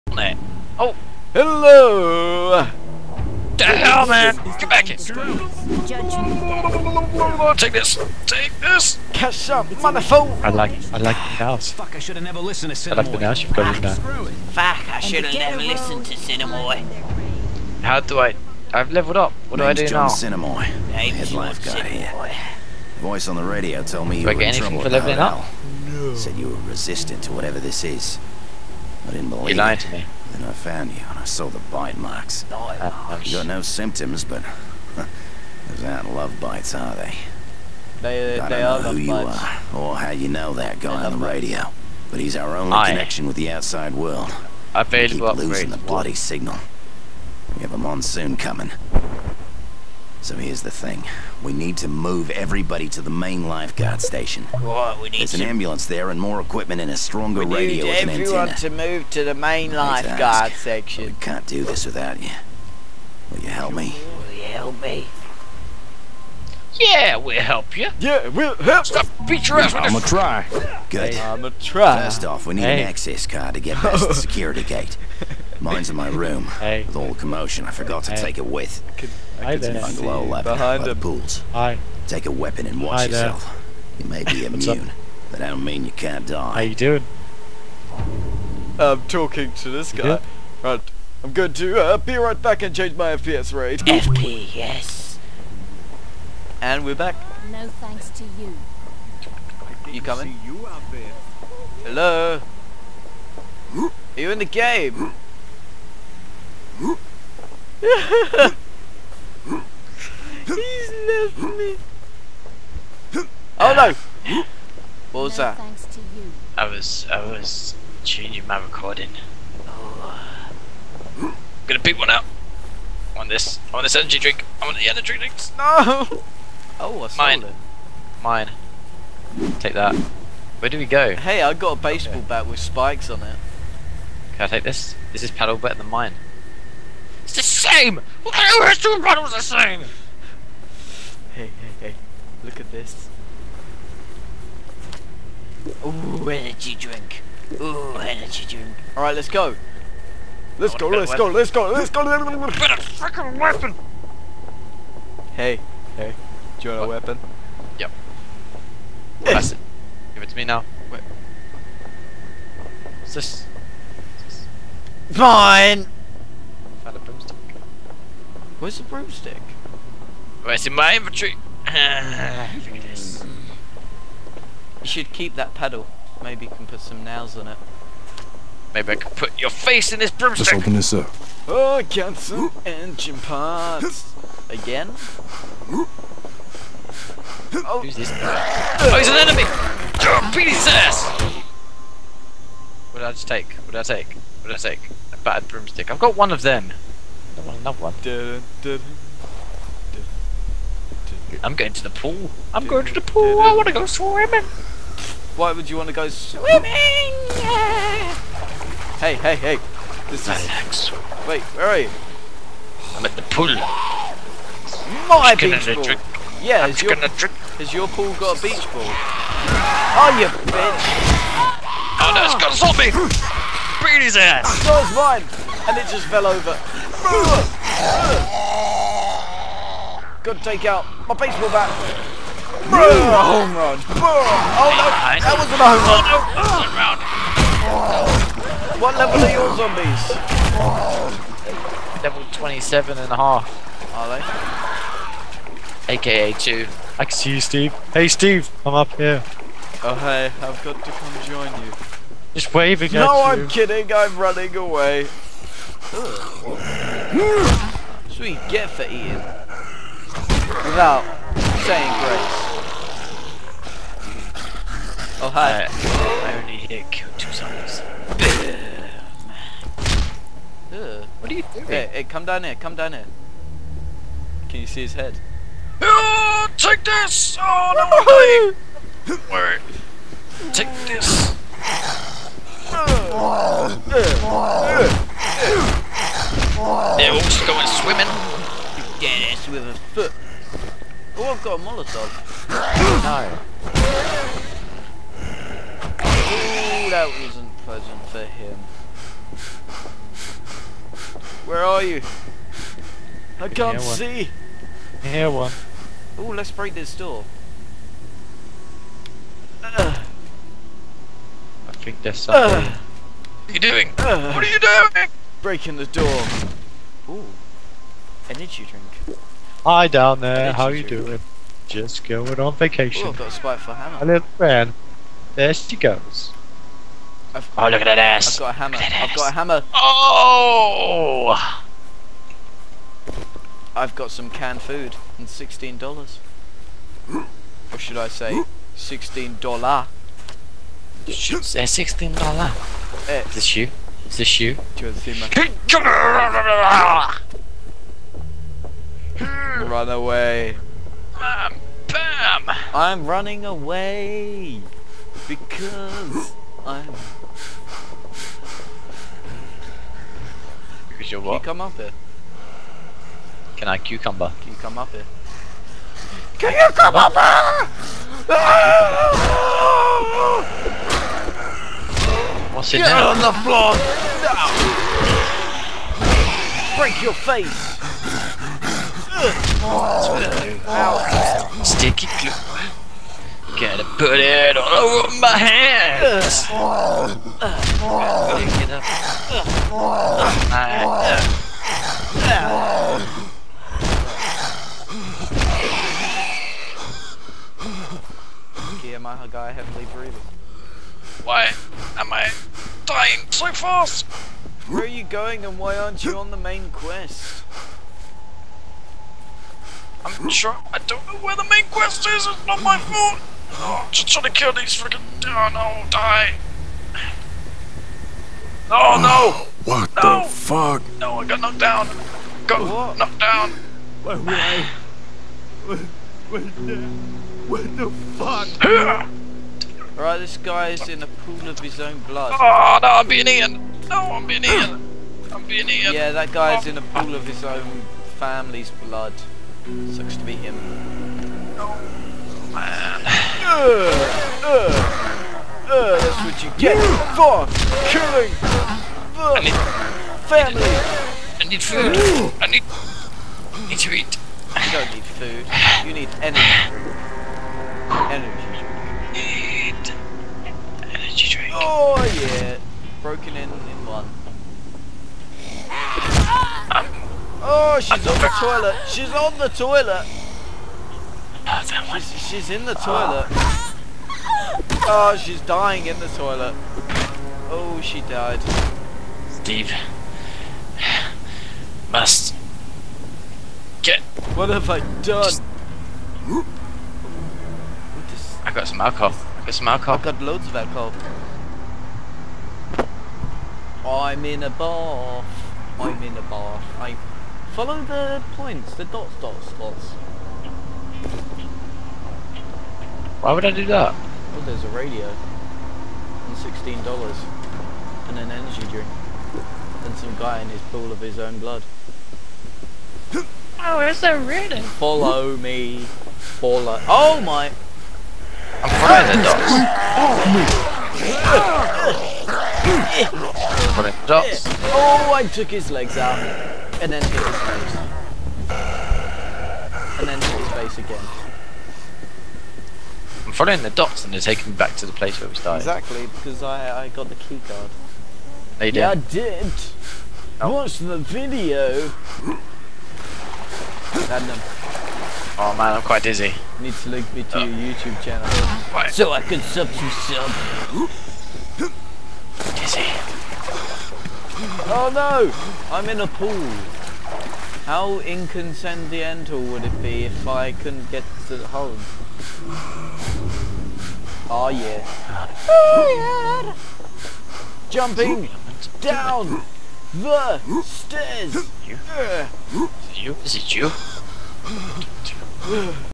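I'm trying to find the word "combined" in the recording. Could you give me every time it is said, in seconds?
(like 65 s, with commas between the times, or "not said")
not said.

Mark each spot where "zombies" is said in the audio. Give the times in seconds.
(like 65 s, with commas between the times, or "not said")
222 s, 239 s, 267 s.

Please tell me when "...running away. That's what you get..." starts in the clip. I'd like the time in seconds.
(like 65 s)
254 s.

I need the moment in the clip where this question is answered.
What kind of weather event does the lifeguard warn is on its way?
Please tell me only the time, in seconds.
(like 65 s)
47 s.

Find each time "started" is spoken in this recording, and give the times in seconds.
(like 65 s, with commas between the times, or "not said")
535 s.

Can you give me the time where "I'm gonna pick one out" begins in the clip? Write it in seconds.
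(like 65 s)
121 s.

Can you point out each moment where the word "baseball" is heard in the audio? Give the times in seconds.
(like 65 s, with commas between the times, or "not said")
131 s, 231 s.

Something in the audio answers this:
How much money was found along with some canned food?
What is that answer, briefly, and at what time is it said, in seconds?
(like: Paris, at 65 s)
$16, at 335 s.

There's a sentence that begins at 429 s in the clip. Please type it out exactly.
Alright, this guy is in a pool of his own blood.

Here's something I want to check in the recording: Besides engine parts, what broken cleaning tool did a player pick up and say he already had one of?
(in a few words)
battered broomstick.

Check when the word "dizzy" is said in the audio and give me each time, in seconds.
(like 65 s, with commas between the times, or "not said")
546 s.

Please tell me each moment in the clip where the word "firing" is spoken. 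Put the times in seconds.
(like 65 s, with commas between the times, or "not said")
518 s.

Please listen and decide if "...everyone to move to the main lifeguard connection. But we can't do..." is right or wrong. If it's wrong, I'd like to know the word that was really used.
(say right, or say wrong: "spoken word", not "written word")
wrong: "section", not "connection".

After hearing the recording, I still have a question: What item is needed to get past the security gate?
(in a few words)
access card.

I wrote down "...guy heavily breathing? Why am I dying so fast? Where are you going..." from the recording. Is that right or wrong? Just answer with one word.
right.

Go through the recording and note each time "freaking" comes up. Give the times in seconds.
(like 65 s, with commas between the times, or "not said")
152 s, 414 s.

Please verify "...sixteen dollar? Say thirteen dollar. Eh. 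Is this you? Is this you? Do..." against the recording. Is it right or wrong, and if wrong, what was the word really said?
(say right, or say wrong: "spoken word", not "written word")
wrong: "sixteen", not "thirteen".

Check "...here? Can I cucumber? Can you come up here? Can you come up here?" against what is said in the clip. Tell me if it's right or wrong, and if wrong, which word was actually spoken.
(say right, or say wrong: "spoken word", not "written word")
right.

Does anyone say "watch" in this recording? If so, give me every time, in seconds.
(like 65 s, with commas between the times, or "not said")
82 s, 540 s.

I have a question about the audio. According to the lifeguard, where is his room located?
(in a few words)
behind the pools.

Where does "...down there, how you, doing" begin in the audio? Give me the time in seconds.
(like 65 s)
319 s.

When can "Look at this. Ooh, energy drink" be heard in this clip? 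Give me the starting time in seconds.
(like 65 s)
142 s.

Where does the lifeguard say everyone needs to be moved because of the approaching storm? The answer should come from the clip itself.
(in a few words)
main lifeguard station.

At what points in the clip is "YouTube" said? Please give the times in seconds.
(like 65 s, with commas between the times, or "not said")
547 s.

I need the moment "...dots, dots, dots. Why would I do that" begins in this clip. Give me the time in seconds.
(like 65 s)
498 s.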